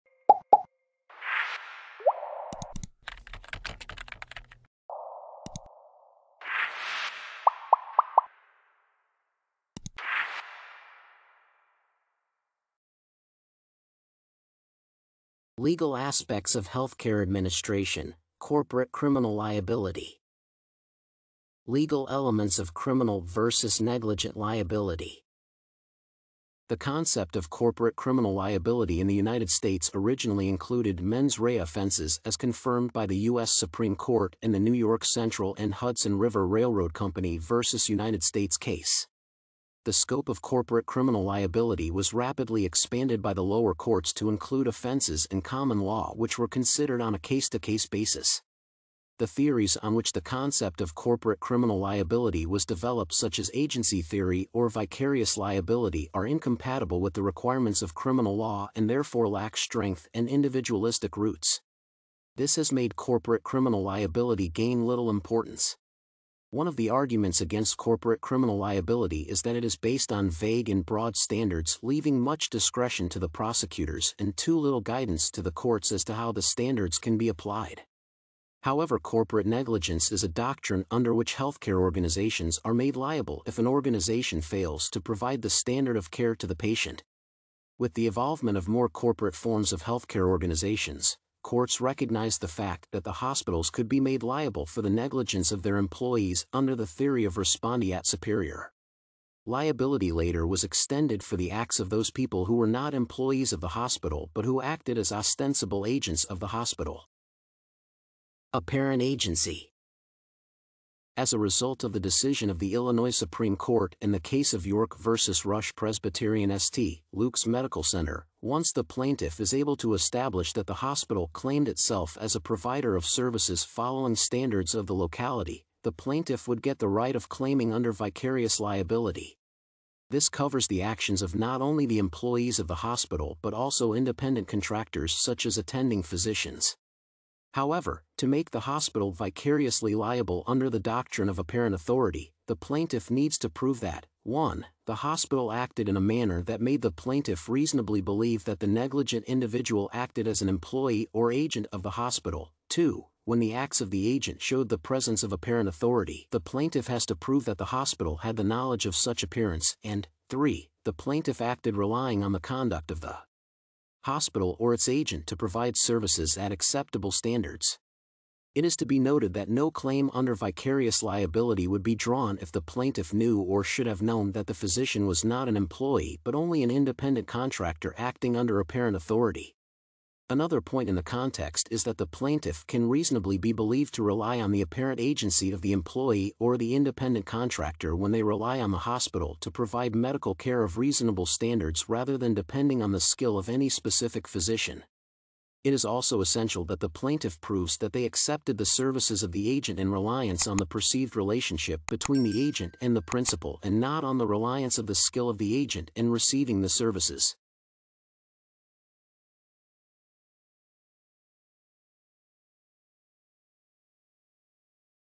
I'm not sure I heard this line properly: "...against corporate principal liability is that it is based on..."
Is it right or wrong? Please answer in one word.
wrong.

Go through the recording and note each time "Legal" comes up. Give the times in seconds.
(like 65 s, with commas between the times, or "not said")
15 s, 21 s.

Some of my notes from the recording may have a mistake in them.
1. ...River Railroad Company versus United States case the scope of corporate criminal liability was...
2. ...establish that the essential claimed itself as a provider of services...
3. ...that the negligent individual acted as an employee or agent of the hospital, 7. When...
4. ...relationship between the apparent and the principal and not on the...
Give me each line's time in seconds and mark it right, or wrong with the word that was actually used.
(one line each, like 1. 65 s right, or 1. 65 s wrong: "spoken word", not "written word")
1. 36 s right
2. 119 s wrong: "hospital", not "essential"
3. 148 s wrong: "2", not "7"
4. 201 s wrong: "agent", not "apparent".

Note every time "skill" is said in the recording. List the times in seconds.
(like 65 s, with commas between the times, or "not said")
193 s, 204 s.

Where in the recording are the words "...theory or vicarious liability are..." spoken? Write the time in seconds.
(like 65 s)
54 s.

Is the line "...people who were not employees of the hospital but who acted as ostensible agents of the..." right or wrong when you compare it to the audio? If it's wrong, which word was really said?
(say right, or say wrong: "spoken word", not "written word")
right.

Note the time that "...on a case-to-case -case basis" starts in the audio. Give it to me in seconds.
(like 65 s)
47 s.